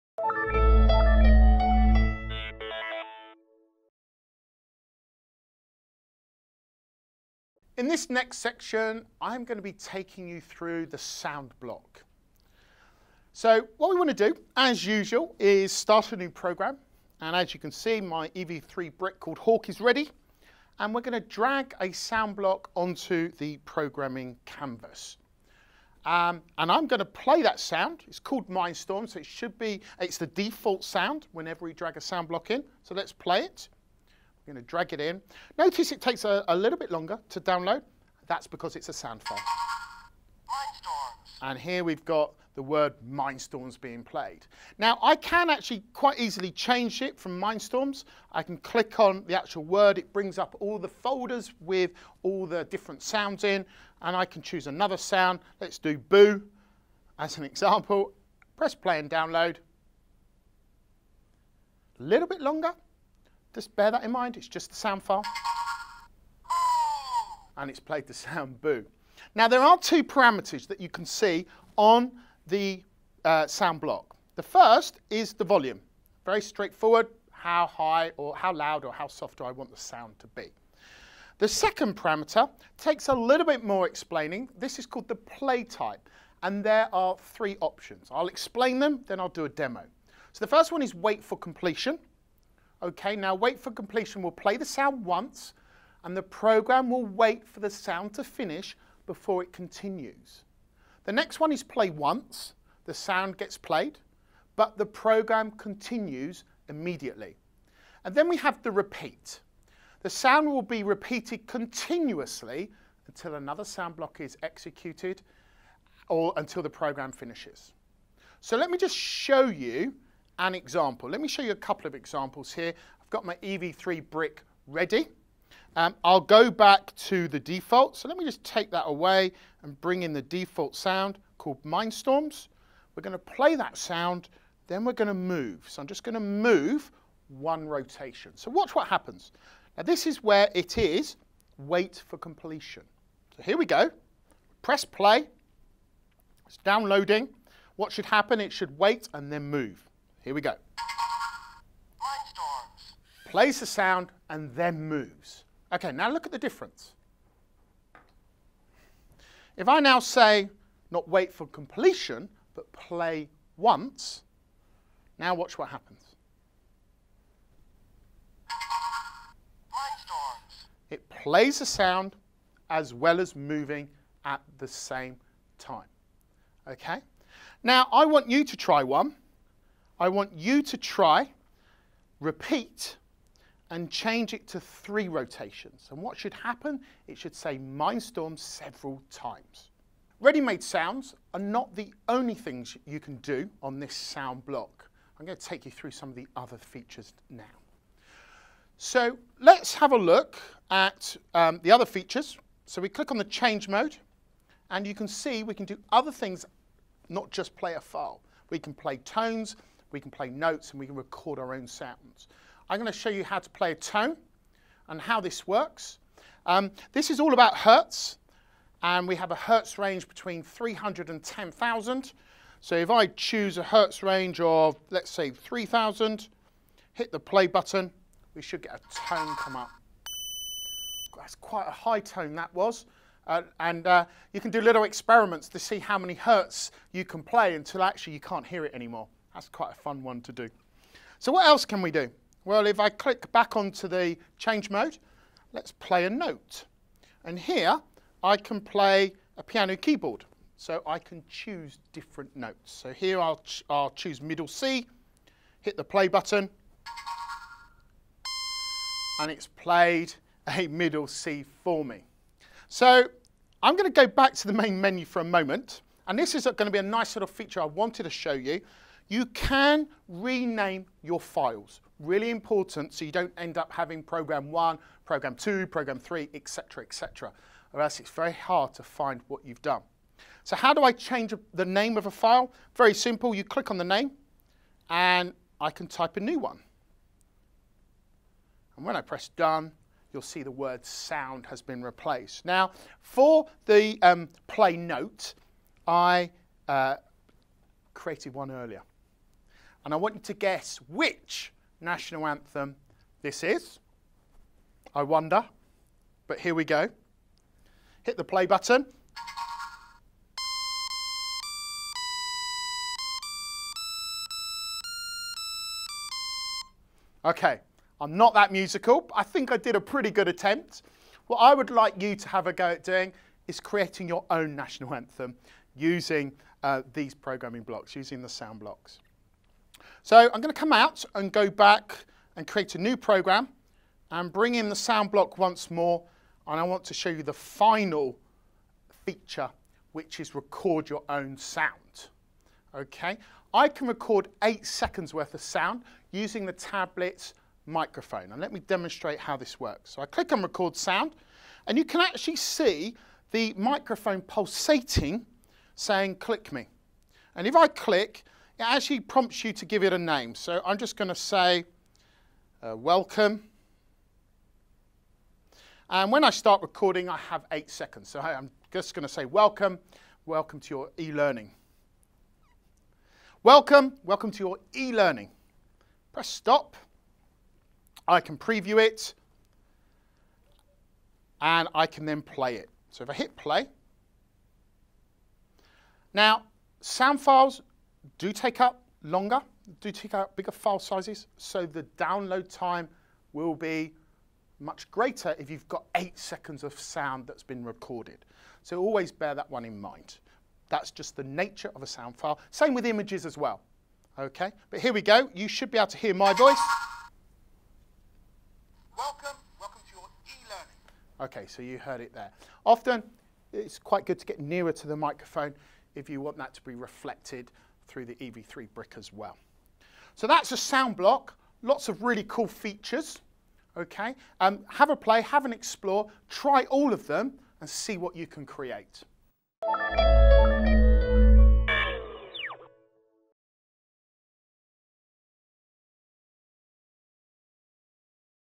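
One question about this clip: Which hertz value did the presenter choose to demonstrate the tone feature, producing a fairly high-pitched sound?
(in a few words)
3,000.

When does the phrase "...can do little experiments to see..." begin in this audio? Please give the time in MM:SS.
03:54.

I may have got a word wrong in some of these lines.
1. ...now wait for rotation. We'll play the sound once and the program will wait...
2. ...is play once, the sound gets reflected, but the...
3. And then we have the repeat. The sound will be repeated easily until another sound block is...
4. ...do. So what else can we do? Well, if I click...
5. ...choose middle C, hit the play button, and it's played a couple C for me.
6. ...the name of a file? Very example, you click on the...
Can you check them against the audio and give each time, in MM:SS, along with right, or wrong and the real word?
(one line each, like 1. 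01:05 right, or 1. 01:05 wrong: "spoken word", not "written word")
1. 01:33 wrong: "completion", not "rotation"
2. 01:41 wrong: "played", not "reflected"
3. 01:48 wrong: "continuously", not "easily"
4. 04:00 right
5. 04:13 wrong: "middle", not "couple"
6. 04:41 wrong: "simple", not "example".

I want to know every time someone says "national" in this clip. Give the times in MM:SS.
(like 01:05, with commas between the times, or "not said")
05:01, 05:24.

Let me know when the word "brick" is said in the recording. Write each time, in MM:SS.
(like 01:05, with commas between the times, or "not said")
00:18, 02:04, 06:58.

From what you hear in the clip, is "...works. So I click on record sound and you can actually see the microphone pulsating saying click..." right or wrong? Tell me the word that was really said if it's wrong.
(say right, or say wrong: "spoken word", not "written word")
right.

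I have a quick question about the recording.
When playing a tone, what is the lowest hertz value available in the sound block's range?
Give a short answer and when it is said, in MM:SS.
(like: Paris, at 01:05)
300, at 03:40.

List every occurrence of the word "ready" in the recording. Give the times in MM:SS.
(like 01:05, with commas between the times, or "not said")
00:19, 02:04, 03:10.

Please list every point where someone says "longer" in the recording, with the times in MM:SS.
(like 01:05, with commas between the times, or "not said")
00:36, 01:02, 06:29.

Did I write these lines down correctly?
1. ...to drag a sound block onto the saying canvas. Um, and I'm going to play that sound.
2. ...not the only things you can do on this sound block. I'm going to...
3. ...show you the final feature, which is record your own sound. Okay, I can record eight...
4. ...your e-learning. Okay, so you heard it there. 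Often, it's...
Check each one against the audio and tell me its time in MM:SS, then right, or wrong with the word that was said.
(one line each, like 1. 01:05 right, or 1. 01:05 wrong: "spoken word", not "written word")
1. 00:21 wrong: "programming", not "saying"
2. 03:11 right
3. 05:36 right
4. 06:49 right.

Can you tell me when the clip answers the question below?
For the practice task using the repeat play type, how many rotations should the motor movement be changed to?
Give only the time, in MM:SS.
03:04.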